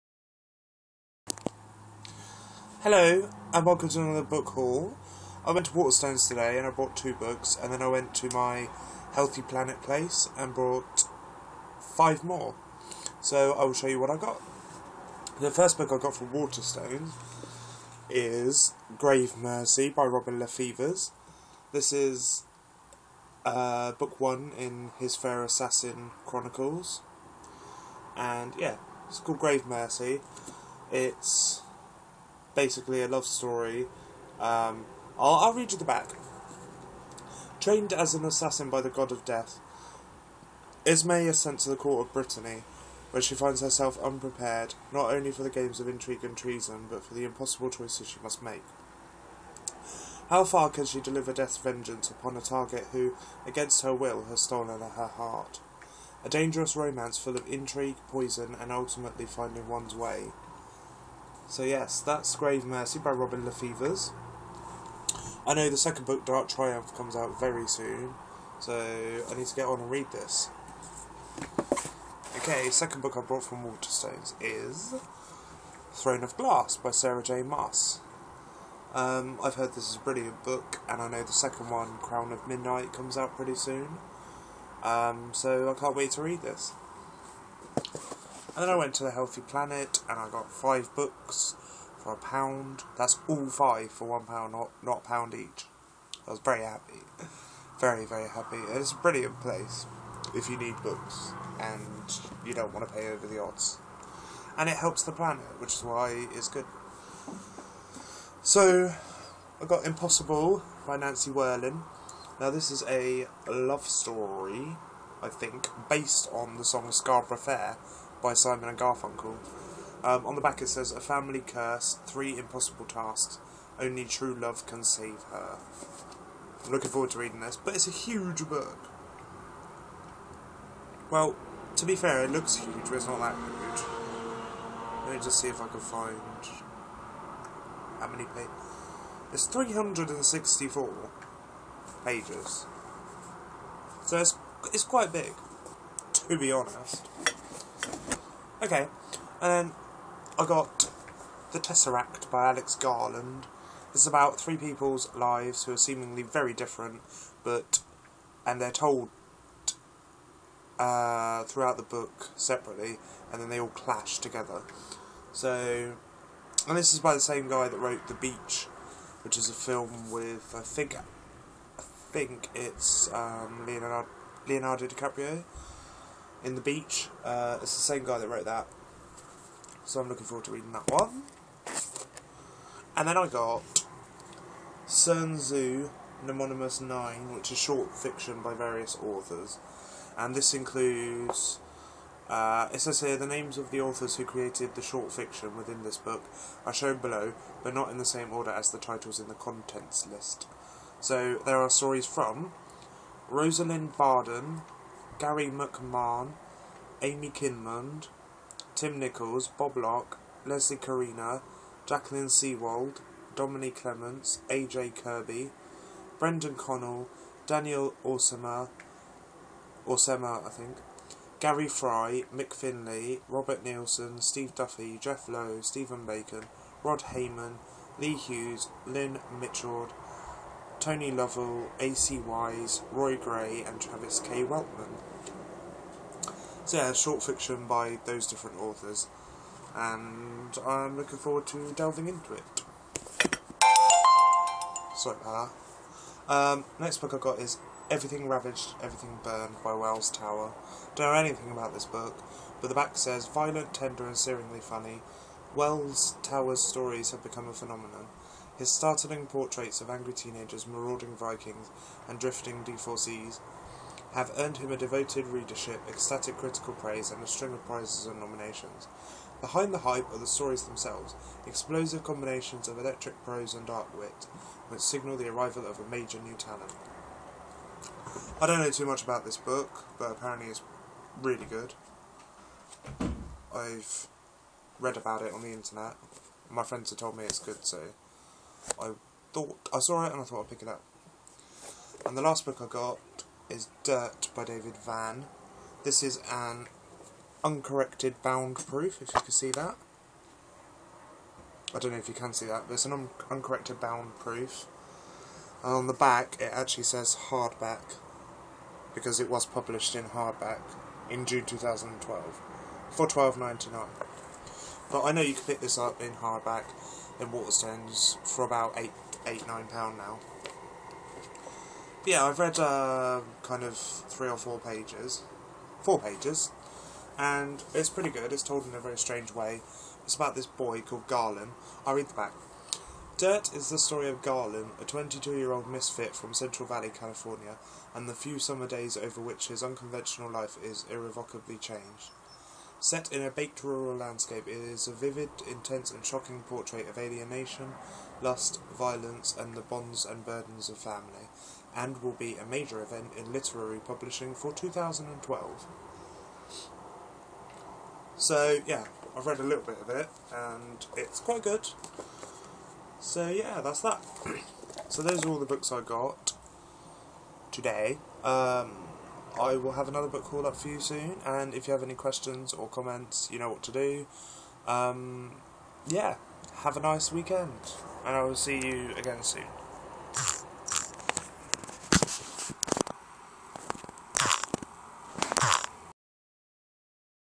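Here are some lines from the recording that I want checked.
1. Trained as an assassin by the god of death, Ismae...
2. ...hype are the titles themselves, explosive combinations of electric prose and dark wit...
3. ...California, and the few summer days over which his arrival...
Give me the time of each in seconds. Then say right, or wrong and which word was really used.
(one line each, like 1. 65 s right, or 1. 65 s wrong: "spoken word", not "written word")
1. 37 s right
2. 269 s wrong: "stories", not "titles"
3. 336 s wrong: "unconventional", not "arrival".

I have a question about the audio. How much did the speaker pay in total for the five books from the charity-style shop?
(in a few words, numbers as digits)
one pound.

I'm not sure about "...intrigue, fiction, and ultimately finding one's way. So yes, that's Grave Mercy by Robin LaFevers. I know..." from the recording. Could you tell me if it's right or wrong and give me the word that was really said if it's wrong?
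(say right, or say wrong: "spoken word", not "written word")
wrong: "poison", not "fiction".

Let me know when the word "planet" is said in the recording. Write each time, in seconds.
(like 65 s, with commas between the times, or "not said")
9 s, 89 s, 105 s.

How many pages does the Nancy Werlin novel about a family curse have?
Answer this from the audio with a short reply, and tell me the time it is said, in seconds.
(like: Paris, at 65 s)
364, at 139 s.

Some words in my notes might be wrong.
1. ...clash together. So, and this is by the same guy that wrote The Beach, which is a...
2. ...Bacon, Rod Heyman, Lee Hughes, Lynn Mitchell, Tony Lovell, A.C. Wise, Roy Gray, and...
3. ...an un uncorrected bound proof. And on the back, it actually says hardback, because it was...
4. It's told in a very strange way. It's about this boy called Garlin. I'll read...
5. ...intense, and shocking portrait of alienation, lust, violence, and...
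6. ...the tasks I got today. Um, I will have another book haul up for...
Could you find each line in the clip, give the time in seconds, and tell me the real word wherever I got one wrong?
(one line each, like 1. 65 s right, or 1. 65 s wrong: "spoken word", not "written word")
1. 163 s right
2. 226 s right
3. 302 s right
4. 328 s right
5. 345 s right
6. 365 s wrong: "books", not "tasks".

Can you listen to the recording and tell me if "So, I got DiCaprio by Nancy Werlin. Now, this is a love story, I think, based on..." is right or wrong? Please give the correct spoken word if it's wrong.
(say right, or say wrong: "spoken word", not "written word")
wrong: "Impossible", not "DiCaprio".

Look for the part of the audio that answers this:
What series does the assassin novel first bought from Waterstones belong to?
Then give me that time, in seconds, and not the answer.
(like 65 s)
25 s.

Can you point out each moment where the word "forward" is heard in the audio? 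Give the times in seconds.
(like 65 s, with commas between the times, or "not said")
126 s, 180 s, 241 s.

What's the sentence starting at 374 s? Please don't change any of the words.
Um, yeah, have a nice weekend, and I will see you again soon.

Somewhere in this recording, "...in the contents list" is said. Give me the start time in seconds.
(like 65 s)
199 s.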